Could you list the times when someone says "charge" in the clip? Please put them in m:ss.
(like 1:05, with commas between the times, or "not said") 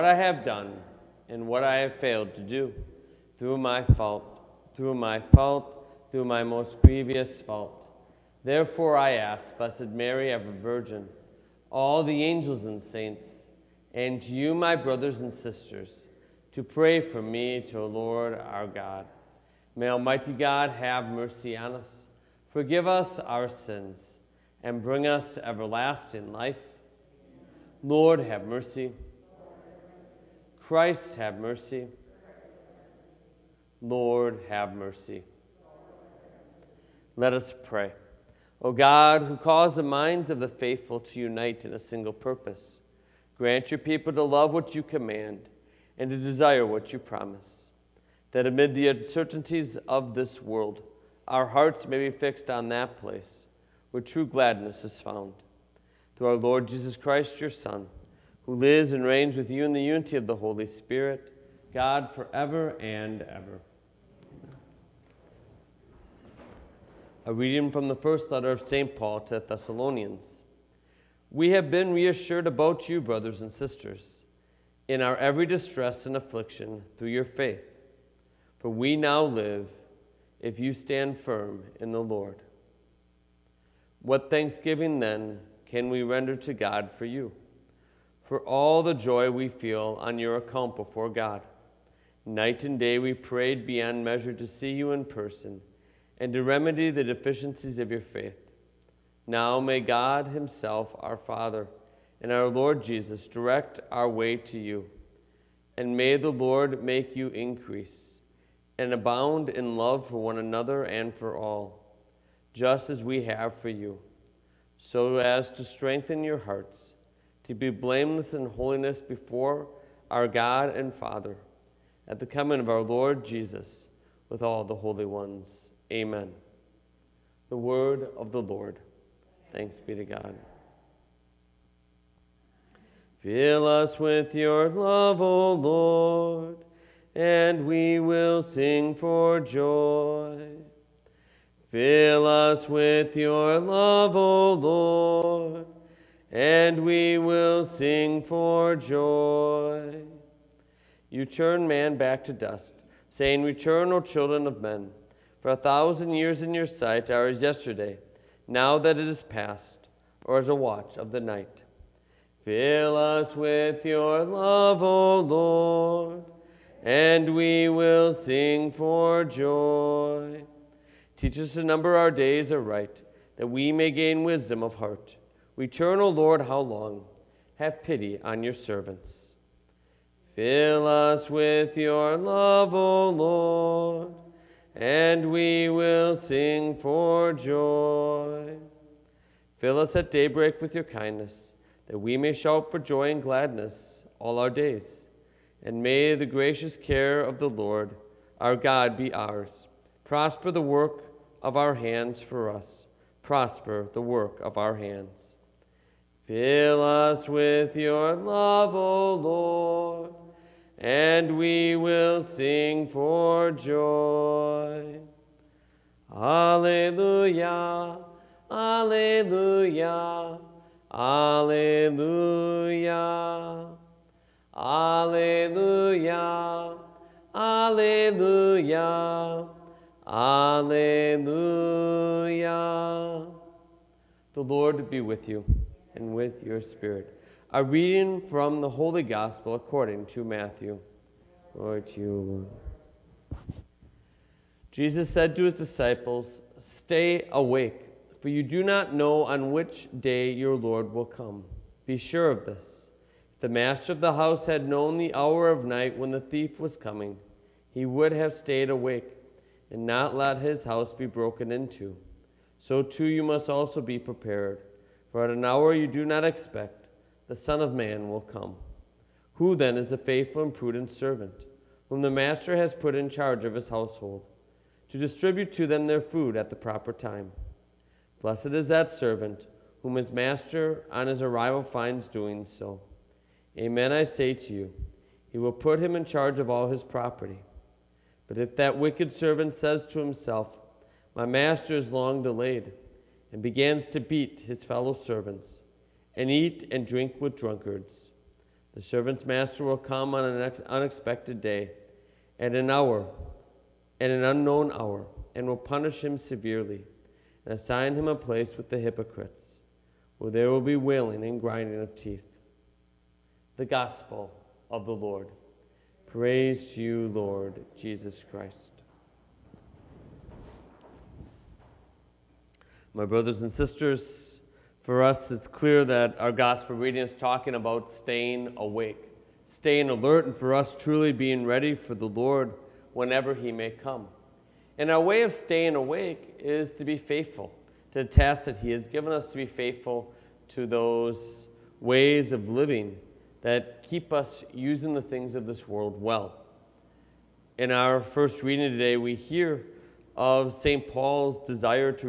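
4:33, 4:46.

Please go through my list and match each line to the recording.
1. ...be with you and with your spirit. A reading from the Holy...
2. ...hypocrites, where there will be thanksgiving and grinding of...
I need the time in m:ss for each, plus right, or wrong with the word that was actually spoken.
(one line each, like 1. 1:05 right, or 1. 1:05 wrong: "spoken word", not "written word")
1. 3:54 right
2. 5:08 wrong: "wailing", not "thanksgiving".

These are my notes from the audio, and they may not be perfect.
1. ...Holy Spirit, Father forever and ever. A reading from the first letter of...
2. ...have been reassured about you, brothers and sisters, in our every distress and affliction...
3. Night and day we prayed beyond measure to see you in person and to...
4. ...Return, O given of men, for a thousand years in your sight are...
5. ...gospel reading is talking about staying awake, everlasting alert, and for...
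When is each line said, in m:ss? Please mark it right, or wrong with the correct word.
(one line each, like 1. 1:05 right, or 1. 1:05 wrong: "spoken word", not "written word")
1. 1:00 wrong: "God", not "Father"
2. 1:11 right
3. 1:32 right
4. 2:33 wrong: "children", not "given"
5. 5:26 wrong: "staying", not "everlasting".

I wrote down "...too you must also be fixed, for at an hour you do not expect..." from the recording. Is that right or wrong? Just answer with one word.
wrong.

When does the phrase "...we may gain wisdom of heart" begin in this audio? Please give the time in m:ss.
2:53.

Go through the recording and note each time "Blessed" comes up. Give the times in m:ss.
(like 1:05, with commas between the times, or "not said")
0:09, 4:38.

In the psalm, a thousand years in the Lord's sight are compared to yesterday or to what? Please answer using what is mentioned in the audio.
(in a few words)
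a watch of the night.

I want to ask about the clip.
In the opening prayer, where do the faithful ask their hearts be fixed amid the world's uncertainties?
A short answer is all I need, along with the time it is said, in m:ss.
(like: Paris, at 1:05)
true gladness, at 0:54.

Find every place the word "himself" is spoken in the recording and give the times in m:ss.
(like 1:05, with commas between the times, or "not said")
1:40, 4:49.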